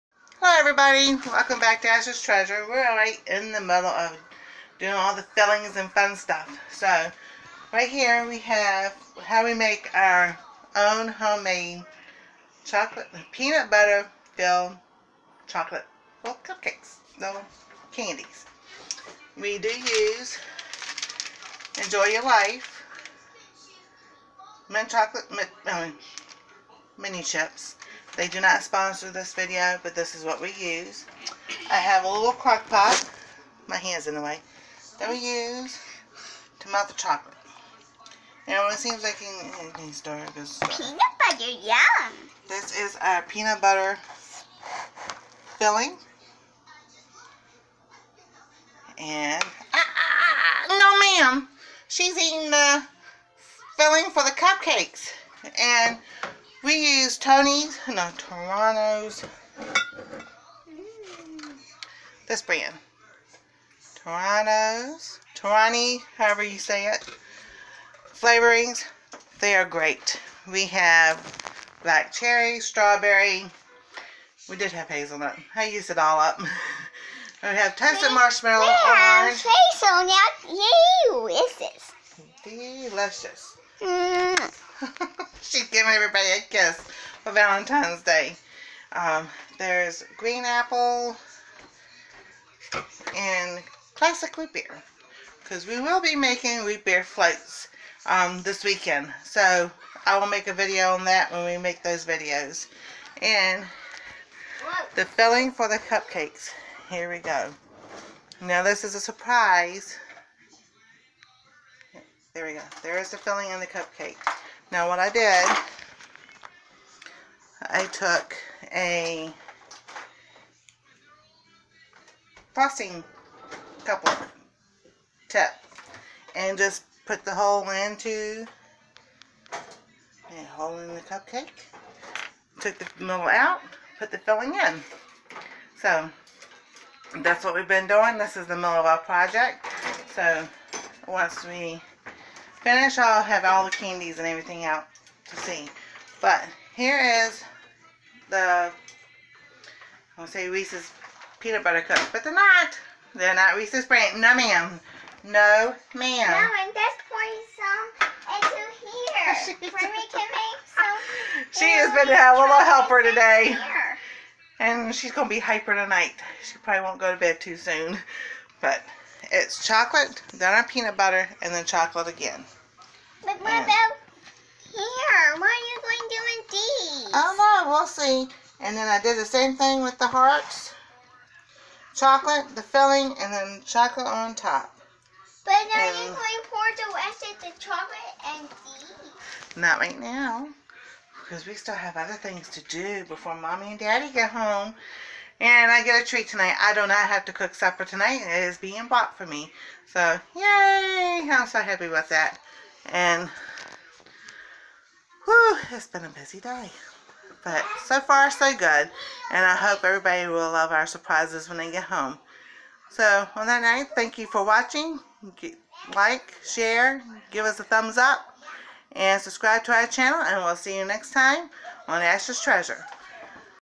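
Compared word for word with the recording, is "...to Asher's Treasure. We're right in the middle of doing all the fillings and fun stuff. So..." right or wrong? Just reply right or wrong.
right.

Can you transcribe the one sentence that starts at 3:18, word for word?
It is being bought for me.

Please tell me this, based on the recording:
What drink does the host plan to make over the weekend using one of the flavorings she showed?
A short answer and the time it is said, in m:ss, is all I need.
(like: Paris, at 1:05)
root beer floats, at 1:36.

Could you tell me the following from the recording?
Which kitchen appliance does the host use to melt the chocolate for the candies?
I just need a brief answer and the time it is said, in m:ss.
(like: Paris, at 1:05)
crock pot, at 0:32.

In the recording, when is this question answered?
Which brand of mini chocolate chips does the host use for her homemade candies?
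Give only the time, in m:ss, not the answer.
0:21.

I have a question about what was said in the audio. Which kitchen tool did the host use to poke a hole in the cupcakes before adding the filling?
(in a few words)
frosting coupler tip.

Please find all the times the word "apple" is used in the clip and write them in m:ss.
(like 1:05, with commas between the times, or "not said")
1:30.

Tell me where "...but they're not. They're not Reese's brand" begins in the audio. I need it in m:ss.
2:32.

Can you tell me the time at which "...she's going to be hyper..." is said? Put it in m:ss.
2:44.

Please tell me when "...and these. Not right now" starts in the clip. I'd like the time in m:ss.
3:08.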